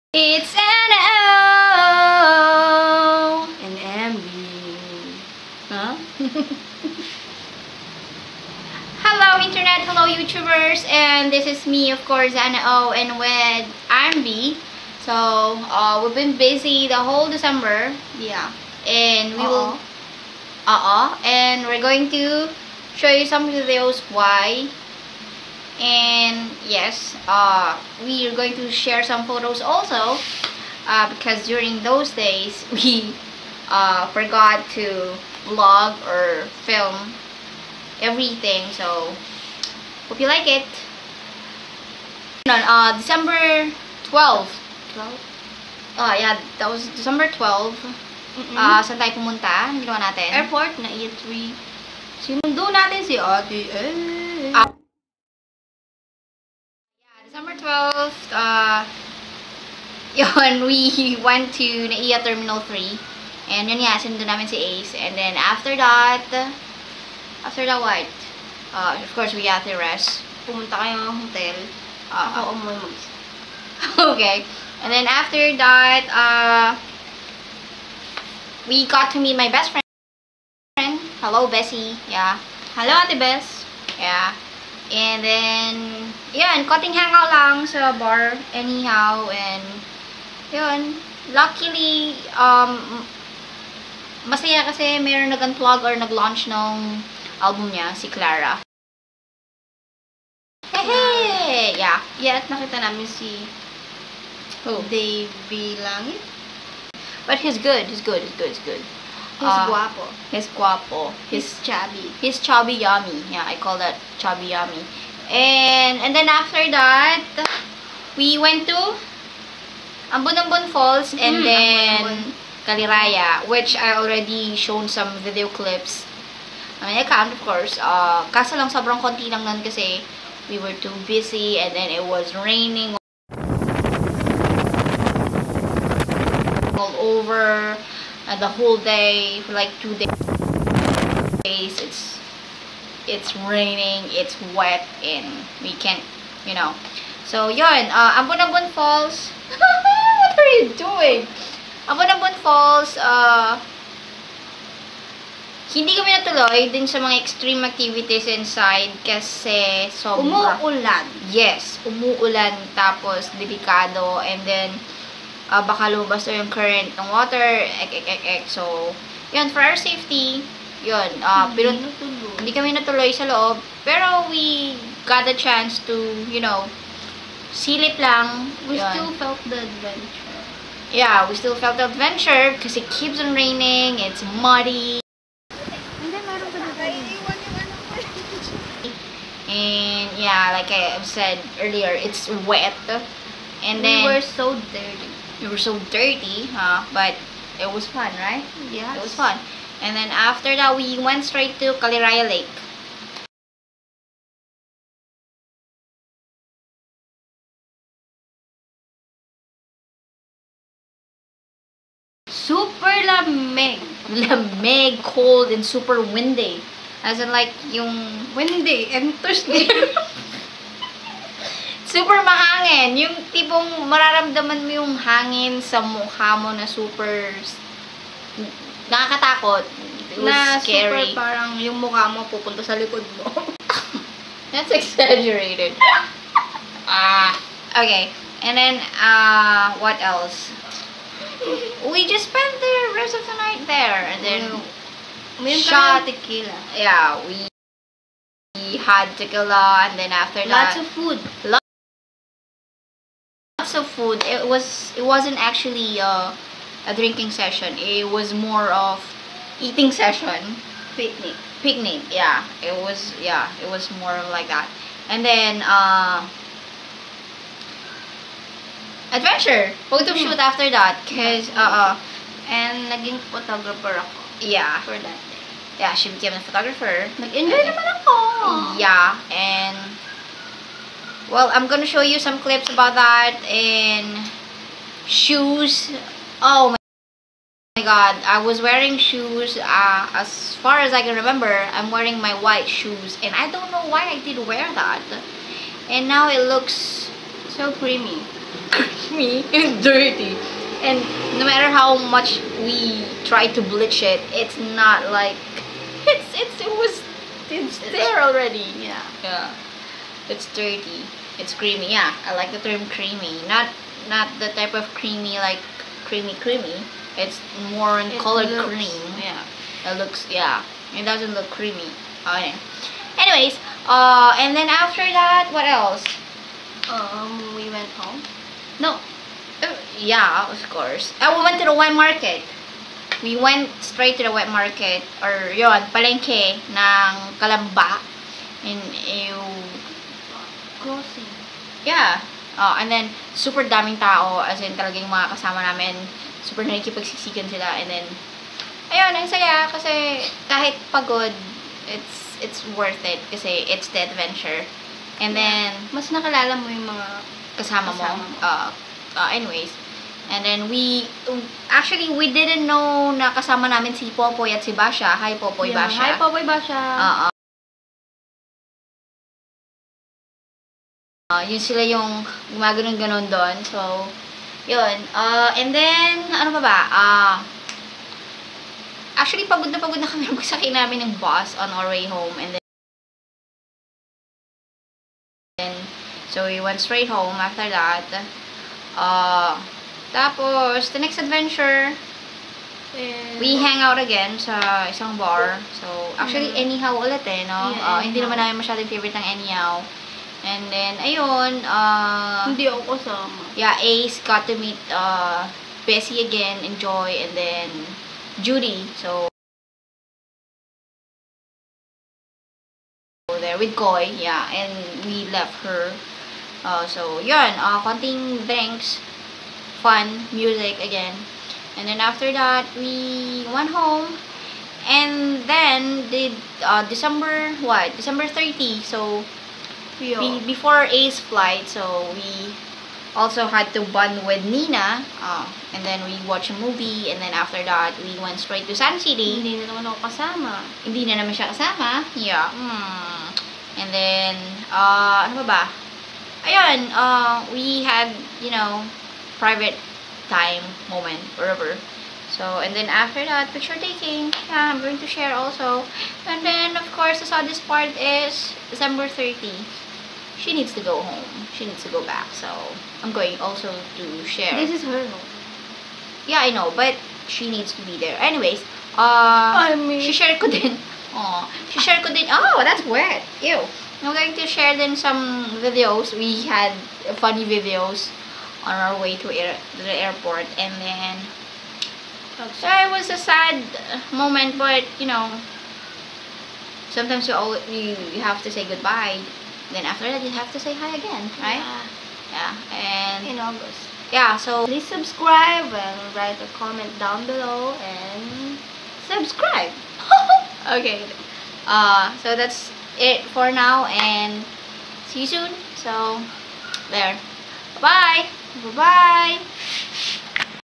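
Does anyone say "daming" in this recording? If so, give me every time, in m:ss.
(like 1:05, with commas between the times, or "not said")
5:43.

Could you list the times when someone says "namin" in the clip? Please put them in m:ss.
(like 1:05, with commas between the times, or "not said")
1:04, 1:42, 5:45, 6:03, 6:20, 6:38.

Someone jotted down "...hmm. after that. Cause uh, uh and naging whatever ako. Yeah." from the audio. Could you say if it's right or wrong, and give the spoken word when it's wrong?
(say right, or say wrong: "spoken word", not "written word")
wrong: "photographer", not "whatever".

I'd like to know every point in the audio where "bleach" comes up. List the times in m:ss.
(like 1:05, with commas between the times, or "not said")
5:03.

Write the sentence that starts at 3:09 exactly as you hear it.
And yeah, like I said earlier, it's wet.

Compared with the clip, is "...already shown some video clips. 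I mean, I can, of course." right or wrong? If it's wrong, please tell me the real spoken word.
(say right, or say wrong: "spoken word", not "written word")
right.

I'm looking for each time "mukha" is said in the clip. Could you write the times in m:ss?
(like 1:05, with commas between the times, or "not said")
3:45, 3:51.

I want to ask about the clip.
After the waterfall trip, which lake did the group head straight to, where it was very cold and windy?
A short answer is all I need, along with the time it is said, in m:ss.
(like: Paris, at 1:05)
Kaliraya Lake, at 3:21.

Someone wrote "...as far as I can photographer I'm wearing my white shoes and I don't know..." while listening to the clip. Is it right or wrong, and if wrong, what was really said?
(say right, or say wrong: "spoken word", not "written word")
wrong: "remember", not "photographer".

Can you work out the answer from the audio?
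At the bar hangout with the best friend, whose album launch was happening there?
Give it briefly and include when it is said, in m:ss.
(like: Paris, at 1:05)
Clara, at 1:38.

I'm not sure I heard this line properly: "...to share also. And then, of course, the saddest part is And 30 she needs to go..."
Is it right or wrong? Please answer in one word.
wrong.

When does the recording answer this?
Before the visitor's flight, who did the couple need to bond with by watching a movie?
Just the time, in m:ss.
7:14.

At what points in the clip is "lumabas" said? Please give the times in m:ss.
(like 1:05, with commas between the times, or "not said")
2:45.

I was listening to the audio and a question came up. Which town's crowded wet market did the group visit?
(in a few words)
Kalamba.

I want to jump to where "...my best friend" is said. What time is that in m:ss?
1:19.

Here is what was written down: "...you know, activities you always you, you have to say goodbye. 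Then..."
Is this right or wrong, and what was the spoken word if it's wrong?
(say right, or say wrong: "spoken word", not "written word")
wrong: "sometimes", not "activities".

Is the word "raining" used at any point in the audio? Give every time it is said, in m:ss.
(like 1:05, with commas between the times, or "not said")
2:12, 2:23, 3:03.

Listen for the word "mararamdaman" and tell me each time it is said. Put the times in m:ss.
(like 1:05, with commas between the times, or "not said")
3:43.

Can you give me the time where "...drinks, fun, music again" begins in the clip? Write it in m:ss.
6:58.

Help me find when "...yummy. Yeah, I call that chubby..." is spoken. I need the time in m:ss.
1:52.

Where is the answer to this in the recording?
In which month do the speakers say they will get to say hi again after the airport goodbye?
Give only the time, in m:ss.
8:13.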